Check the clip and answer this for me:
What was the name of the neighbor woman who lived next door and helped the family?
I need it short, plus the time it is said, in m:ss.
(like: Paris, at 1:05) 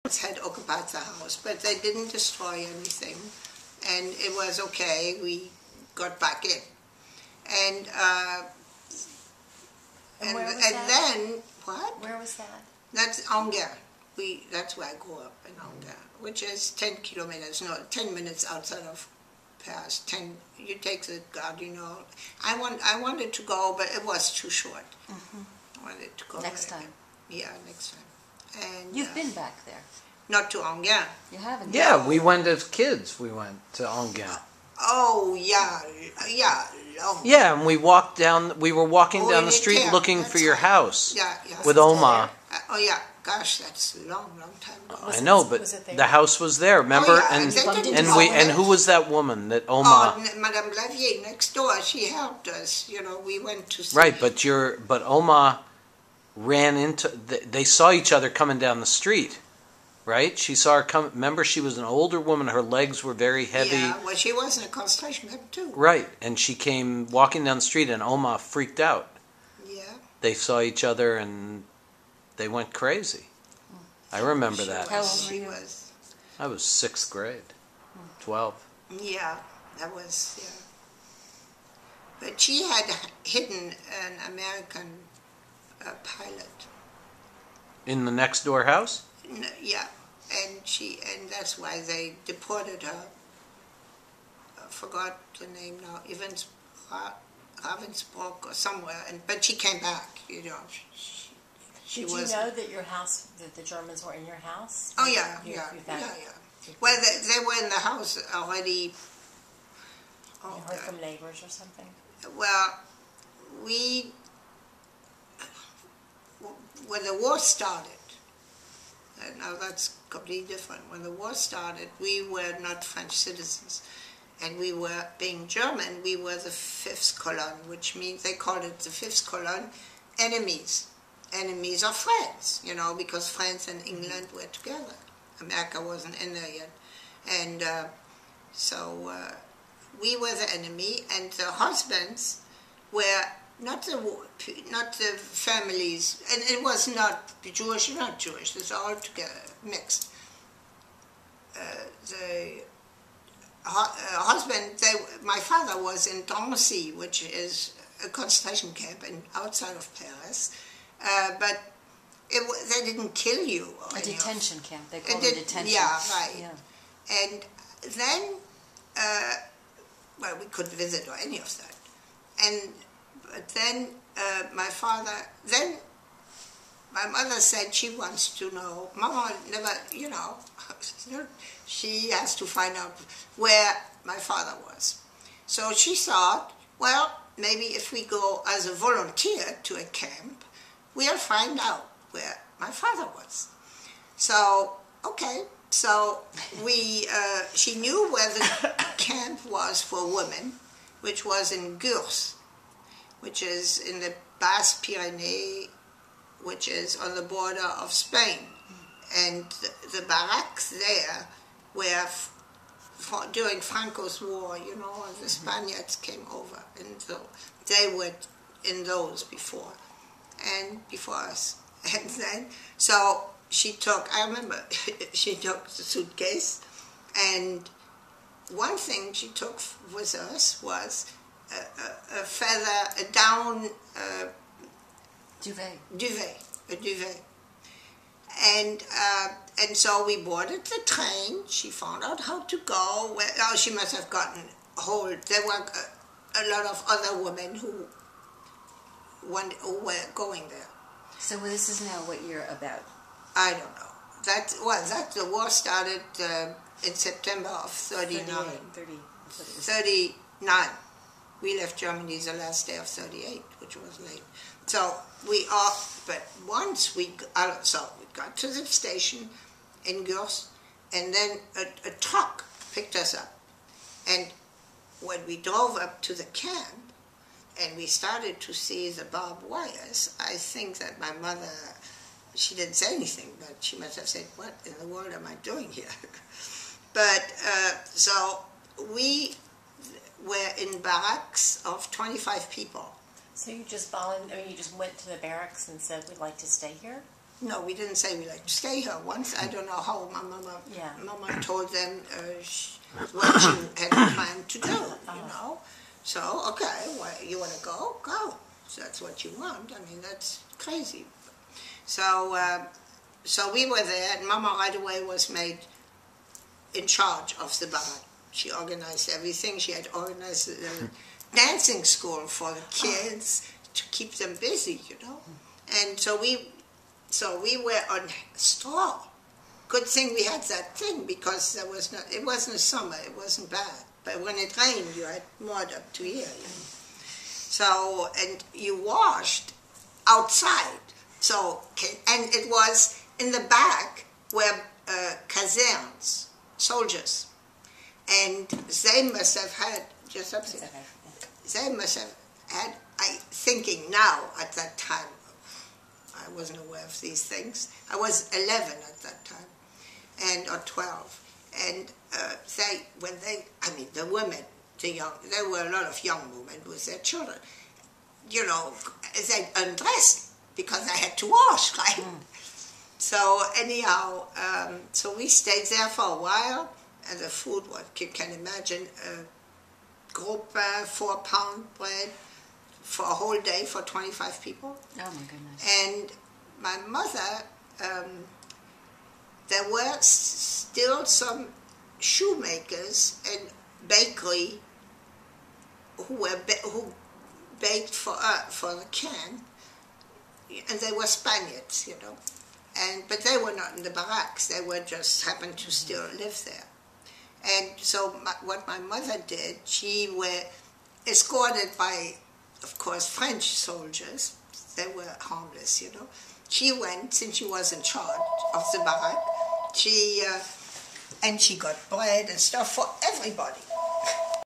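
Madame Blavier, at 0:50.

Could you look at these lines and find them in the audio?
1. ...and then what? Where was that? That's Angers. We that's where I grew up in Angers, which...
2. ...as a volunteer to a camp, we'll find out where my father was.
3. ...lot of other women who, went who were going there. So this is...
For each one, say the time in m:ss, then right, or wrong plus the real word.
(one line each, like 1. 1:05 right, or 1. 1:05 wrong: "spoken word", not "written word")
1. 0:10 right
2. 3:08 right
3. 4:06 right.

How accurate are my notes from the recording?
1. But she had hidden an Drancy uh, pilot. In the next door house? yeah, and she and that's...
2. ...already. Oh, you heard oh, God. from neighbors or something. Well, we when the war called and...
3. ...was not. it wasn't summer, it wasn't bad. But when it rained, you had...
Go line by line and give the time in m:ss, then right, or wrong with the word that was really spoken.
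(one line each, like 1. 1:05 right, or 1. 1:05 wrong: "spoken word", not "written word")
1. 1:22 wrong: "American", not "Drancy"
2. 1:48 wrong: "started", not "called"
3. 5:31 right.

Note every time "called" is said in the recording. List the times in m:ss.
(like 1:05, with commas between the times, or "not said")
2:08, 2:45.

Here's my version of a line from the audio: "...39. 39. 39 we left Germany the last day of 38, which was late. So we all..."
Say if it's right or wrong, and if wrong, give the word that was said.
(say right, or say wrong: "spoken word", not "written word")
right.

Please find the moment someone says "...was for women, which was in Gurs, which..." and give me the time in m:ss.
3:19.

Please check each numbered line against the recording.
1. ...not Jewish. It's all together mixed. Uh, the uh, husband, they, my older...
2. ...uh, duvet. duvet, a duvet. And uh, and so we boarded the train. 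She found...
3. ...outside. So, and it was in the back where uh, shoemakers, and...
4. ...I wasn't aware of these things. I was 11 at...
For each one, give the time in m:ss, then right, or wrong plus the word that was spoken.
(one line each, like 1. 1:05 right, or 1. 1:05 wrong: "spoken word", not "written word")
1. 2:27 wrong: "father", not "older"
2. 3:53 right
3. 5:40 wrong: "soldiers", not "shoemakers"
4. 5:56 right.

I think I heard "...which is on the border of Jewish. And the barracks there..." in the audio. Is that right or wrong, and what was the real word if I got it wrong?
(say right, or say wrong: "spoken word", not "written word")
wrong: "Spain", not "Jewish".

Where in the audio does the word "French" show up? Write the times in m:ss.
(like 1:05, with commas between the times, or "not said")
2:02, 6:53.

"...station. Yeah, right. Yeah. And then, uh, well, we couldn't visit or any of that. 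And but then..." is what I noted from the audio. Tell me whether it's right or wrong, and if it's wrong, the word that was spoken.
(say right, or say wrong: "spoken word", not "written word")
wrong: "detention", not "station".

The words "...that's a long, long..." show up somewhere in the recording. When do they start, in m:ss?
0:43.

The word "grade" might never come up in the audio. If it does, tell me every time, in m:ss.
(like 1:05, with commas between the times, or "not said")
1:17.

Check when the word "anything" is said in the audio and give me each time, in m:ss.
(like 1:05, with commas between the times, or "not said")
0:02, 4:42.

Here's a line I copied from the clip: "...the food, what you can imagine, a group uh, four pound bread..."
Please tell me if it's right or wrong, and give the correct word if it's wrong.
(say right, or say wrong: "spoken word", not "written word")
right.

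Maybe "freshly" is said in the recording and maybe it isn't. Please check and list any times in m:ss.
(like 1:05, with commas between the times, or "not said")
not said.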